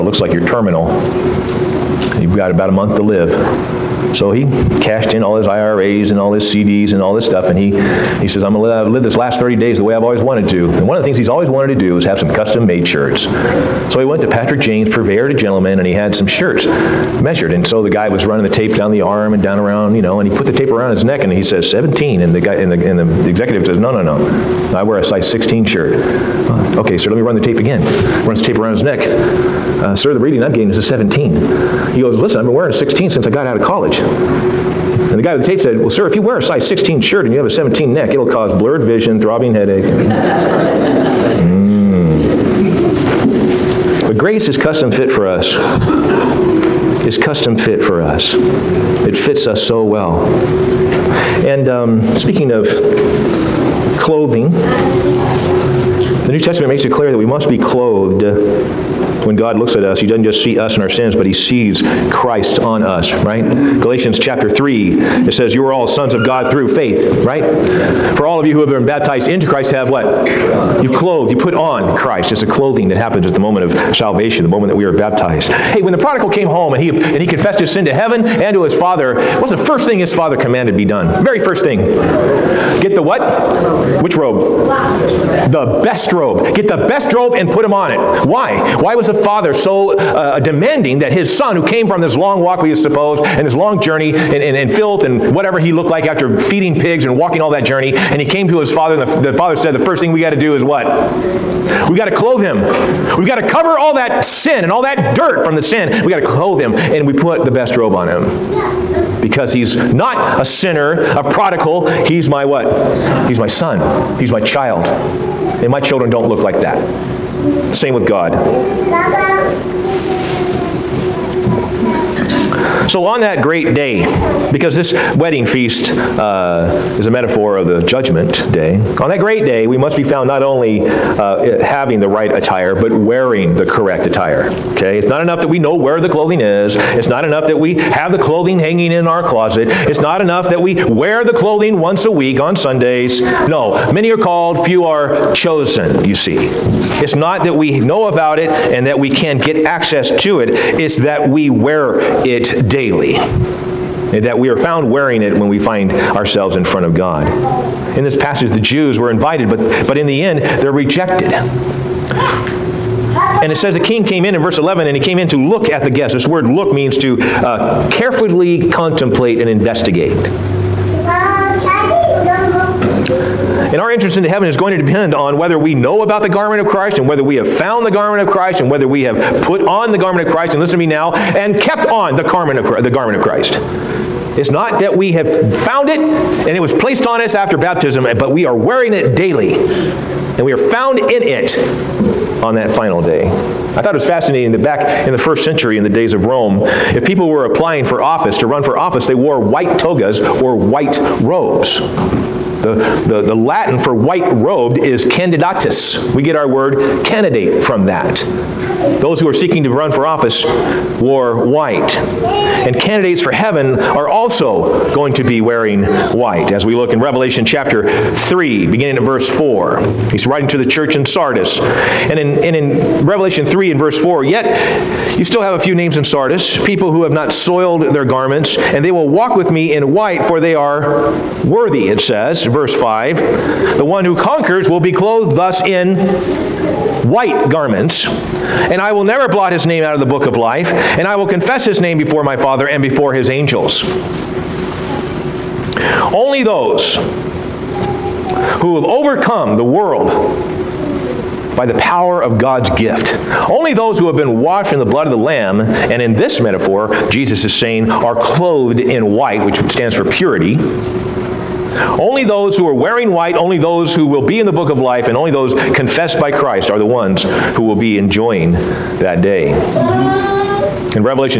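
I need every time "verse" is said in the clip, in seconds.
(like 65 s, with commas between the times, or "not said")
164 s, 219 s, 223 s, 232 s.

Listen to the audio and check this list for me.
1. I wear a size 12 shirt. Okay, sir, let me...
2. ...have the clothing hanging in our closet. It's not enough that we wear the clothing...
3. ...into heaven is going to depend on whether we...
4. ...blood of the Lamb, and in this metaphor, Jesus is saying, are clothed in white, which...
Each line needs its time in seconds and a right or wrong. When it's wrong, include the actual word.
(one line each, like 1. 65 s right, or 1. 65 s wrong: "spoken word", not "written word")
1. 24 s wrong: "16", not "12"
2. 137 s right
3. 174 s right
4. 254 s right.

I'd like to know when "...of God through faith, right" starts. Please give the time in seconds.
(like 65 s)
66 s.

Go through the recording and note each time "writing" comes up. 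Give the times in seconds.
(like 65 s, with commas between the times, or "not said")
220 s.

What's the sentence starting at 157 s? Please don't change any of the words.
In this passage, the Jews were invited, but, but in the end, they're rejected.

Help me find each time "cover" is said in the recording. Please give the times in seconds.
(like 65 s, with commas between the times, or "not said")
103 s.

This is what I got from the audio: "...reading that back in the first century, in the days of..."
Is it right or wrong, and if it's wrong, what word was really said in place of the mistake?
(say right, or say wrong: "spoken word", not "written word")
wrong: "fascinating", not "reading".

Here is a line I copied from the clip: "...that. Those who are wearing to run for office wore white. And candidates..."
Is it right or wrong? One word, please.
wrong.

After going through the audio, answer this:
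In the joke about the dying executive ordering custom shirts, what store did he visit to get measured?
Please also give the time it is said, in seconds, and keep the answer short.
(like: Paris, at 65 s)
Patrick James, at 14 s.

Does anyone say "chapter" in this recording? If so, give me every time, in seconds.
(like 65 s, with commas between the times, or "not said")
64 s, 217 s.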